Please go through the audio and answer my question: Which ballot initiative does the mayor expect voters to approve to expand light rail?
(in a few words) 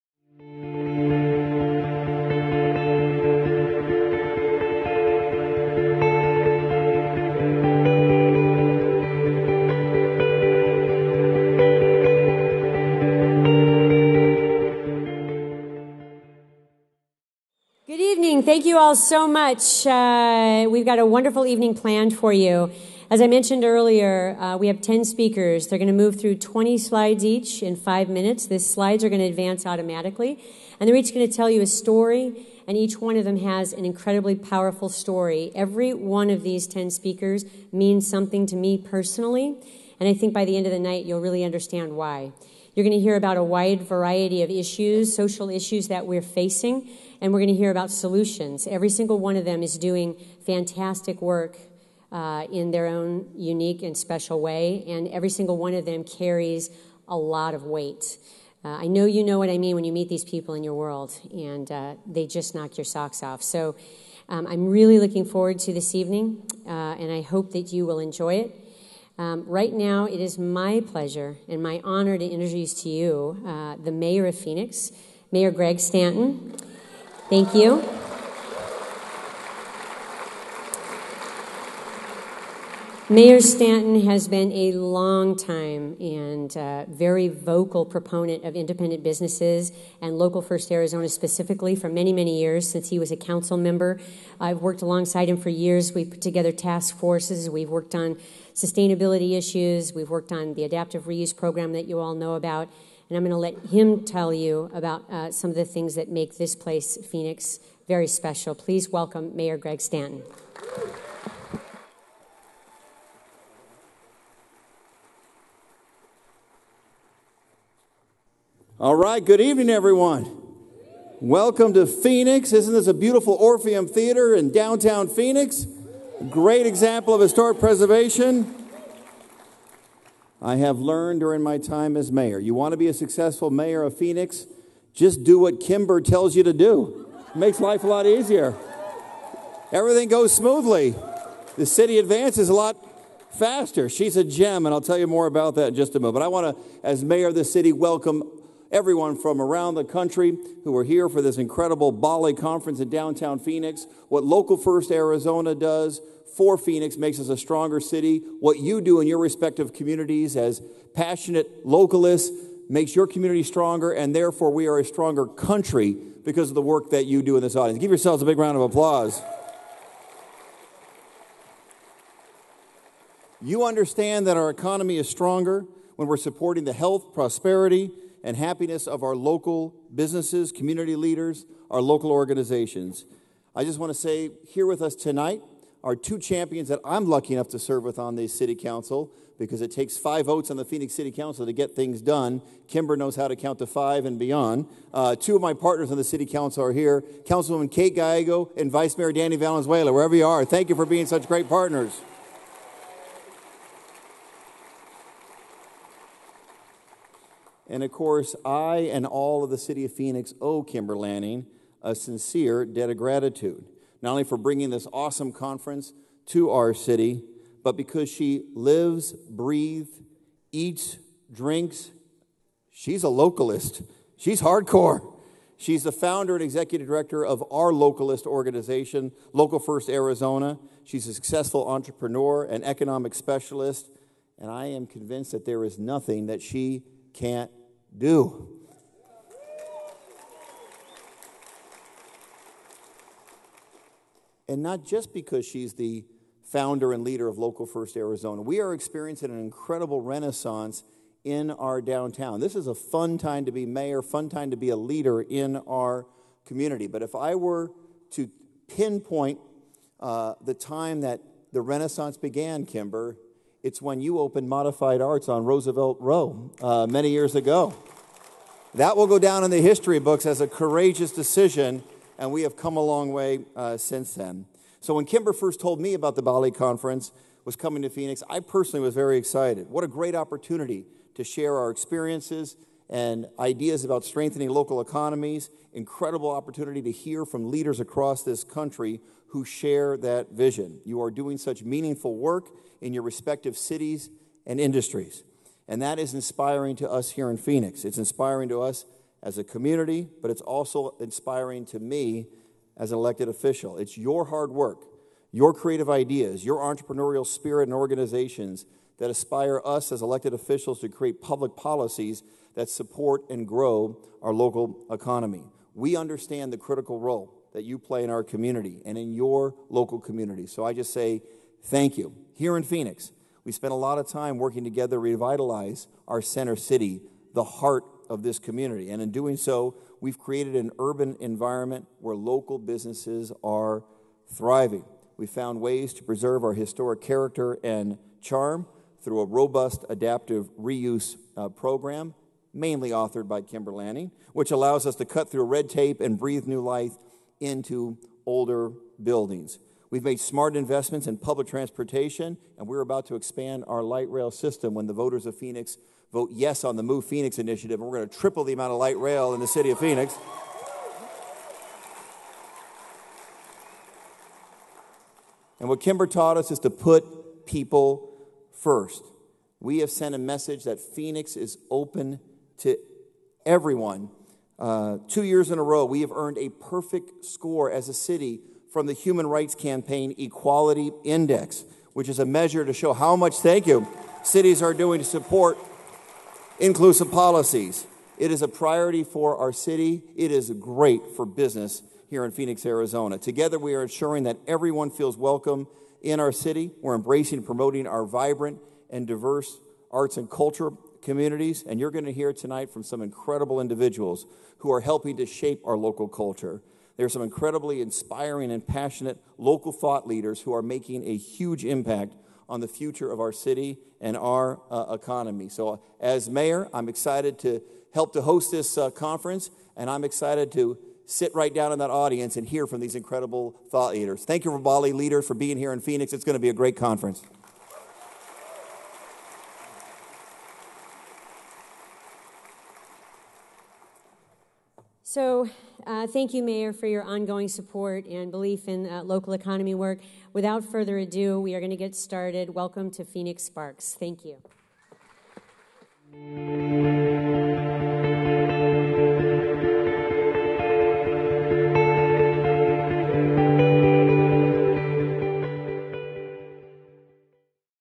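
Move Phoenix.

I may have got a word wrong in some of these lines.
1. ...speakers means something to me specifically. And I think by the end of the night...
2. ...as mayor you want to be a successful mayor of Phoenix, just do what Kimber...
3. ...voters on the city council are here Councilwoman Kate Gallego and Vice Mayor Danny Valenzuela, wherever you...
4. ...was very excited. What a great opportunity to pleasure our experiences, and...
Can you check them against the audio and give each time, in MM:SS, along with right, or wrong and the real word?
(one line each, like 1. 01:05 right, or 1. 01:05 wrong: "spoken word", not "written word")
1. 00:36 wrong: "personally", not "specifically"
2. 02:11 right
3. 03:15 wrong: "partners", not "voters"
4. 04:38 wrong: "share", not "pleasure".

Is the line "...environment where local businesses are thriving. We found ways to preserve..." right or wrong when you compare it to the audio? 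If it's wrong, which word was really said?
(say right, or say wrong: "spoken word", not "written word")
right.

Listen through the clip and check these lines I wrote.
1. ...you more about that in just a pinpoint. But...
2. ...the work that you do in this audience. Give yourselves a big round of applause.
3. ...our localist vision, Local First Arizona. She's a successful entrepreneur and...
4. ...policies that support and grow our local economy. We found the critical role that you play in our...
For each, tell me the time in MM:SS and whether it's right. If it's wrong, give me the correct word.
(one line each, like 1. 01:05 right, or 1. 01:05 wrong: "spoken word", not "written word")
1. 02:24 wrong: "moment", not "pinpoint"
2. 02:46 right
3. 03:47 wrong: "organization", not "vision"
4. 05:11 wrong: "understand", not "found".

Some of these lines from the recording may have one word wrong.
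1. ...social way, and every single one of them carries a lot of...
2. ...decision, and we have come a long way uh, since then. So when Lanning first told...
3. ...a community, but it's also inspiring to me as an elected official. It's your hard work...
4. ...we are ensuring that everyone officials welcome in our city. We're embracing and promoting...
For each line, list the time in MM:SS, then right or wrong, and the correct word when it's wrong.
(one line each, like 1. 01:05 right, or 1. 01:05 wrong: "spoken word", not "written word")
1. 00:53 wrong: "special", not "social"
2. 04:31 wrong: "Kimber", not "Lanning"
3. 04:59 right
4. 06:33 wrong: "feels", not "officials".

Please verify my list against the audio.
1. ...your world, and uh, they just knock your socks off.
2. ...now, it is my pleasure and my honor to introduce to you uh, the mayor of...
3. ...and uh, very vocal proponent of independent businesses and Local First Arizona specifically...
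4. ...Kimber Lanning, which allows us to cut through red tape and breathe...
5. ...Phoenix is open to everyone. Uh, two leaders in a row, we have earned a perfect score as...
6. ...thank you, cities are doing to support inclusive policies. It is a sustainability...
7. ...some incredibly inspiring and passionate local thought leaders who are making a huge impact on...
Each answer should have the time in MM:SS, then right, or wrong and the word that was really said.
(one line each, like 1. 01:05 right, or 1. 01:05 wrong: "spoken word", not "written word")
1. 01:00 right
2. 01:09 right
3. 01:25 right
4. 05:43 right
5. 06:10 wrong: "years", not "leaders"
6. 06:23 wrong: "priority", not "sustainability"
7. 06:47 right.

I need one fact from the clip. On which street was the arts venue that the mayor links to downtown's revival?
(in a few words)
Roosevelt Row.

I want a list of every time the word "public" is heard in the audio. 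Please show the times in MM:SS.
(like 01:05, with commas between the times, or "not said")
05:11, 05:51.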